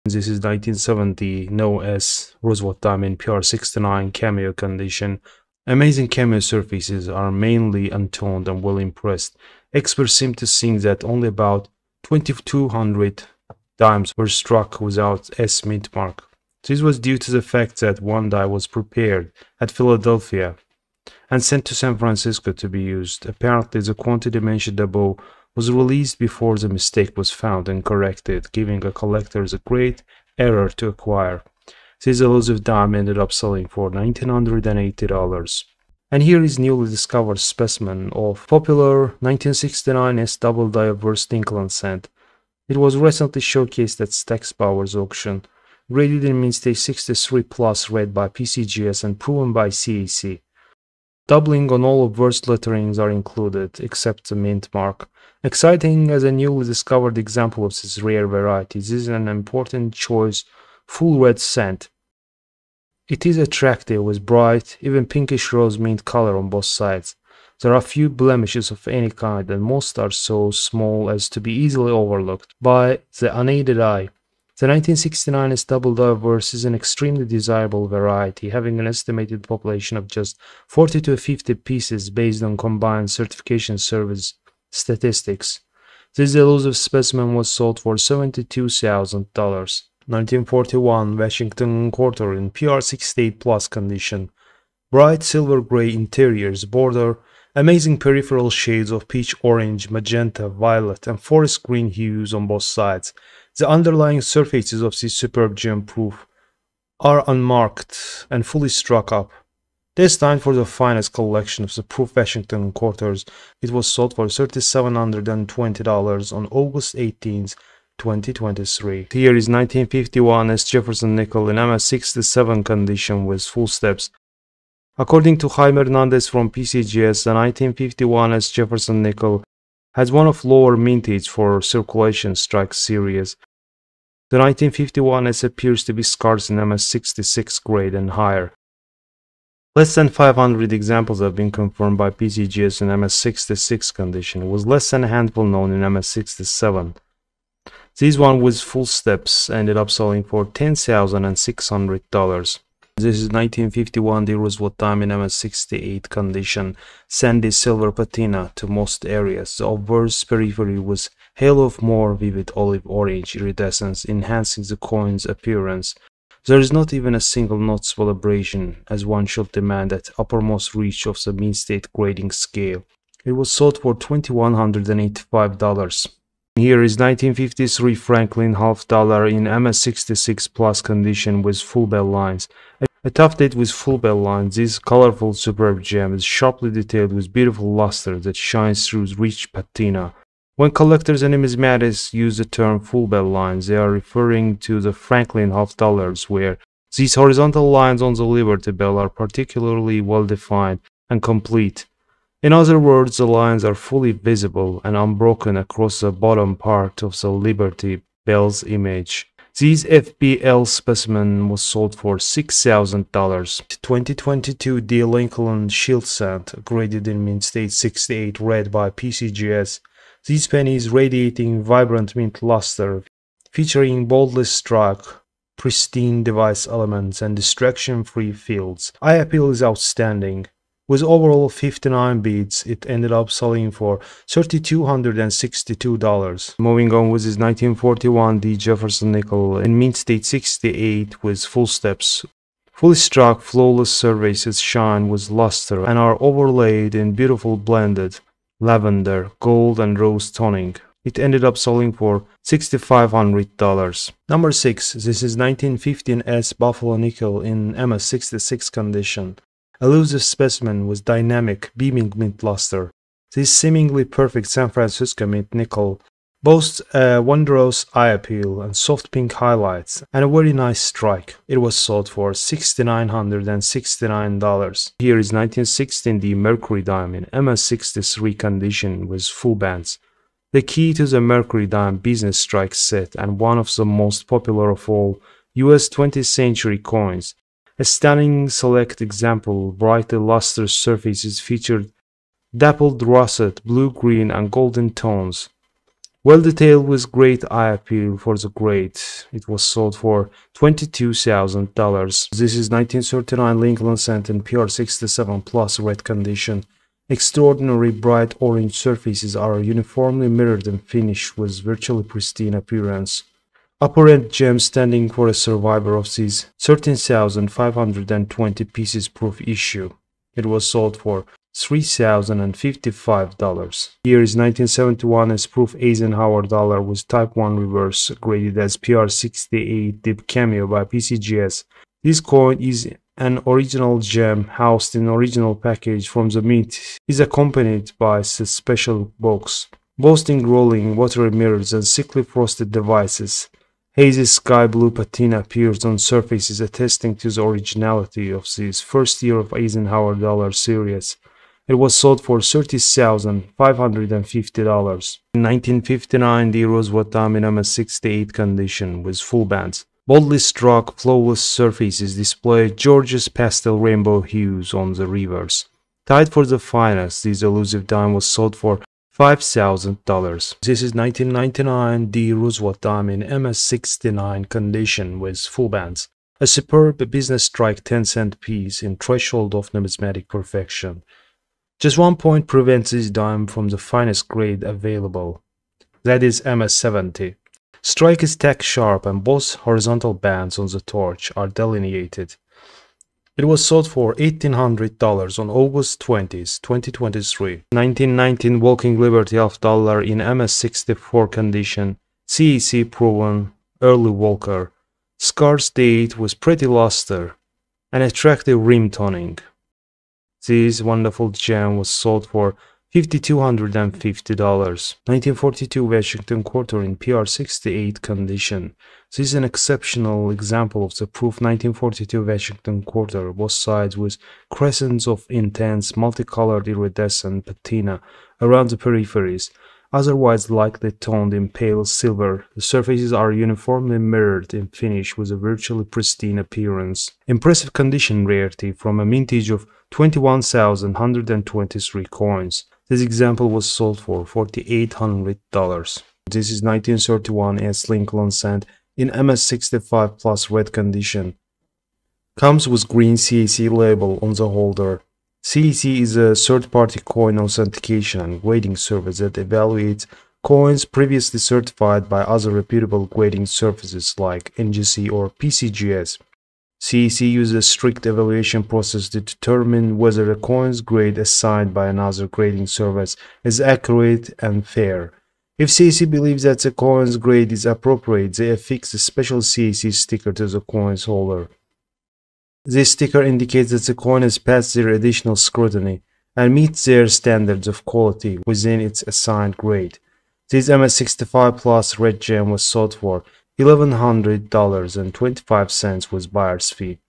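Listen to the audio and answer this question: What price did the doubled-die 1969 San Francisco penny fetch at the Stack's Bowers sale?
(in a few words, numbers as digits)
$72,000.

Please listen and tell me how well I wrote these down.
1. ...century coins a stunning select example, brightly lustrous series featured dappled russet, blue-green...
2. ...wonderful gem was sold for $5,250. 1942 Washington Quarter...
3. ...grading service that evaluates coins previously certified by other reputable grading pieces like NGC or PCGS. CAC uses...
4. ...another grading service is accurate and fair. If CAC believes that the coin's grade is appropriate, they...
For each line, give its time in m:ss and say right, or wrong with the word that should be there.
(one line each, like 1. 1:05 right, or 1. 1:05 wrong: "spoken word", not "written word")
1. 4:46 wrong: "surfaces", not "series"
2. 6:50 right
3. 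7:38 wrong: "services", not "pieces"
4. 7:51 right.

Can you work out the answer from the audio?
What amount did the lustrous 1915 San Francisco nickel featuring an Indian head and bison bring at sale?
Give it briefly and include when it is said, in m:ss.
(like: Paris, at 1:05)
$6,969, at 4:32.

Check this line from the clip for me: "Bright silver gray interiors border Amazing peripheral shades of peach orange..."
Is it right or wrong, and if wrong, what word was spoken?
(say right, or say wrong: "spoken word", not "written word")
right.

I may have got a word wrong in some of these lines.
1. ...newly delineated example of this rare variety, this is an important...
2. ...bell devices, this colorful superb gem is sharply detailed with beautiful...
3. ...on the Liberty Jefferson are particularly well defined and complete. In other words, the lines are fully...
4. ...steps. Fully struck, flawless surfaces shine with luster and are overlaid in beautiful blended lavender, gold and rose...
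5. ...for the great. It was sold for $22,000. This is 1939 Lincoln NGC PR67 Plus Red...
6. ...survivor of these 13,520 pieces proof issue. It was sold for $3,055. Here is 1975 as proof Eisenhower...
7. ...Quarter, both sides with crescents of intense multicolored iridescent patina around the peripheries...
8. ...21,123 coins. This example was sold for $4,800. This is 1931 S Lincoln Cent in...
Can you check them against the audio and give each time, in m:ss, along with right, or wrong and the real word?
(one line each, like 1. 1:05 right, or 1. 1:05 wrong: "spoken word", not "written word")
1. 0:56 wrong: "discovered", not "delineated"
2. 3:03 wrong: "lines", not "devices"
3. 3:18 wrong: "Bell", not "Jefferson"
4. 4:01 right
5. 4:58 wrong: "Center", not "NGC"
6. 5:15 wrong: "1971", not "1975"
7. 7:02 right
8. 7:19 right.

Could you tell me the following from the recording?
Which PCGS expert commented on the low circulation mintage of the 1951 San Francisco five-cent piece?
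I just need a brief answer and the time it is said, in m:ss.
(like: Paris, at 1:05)
Jaime Hernandez, at 2:05.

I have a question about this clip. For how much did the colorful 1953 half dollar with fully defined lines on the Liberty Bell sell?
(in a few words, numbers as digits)
$6,000.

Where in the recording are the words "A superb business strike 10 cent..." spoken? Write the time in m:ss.
6:16.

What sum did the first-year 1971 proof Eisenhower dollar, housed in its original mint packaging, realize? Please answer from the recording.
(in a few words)
$30,550.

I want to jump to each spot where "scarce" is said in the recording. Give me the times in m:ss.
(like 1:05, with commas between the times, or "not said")
2:16, 6:45.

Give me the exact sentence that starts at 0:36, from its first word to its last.
And here is newly discovered specimen of popular 1969 S double diverse Lincoln cent.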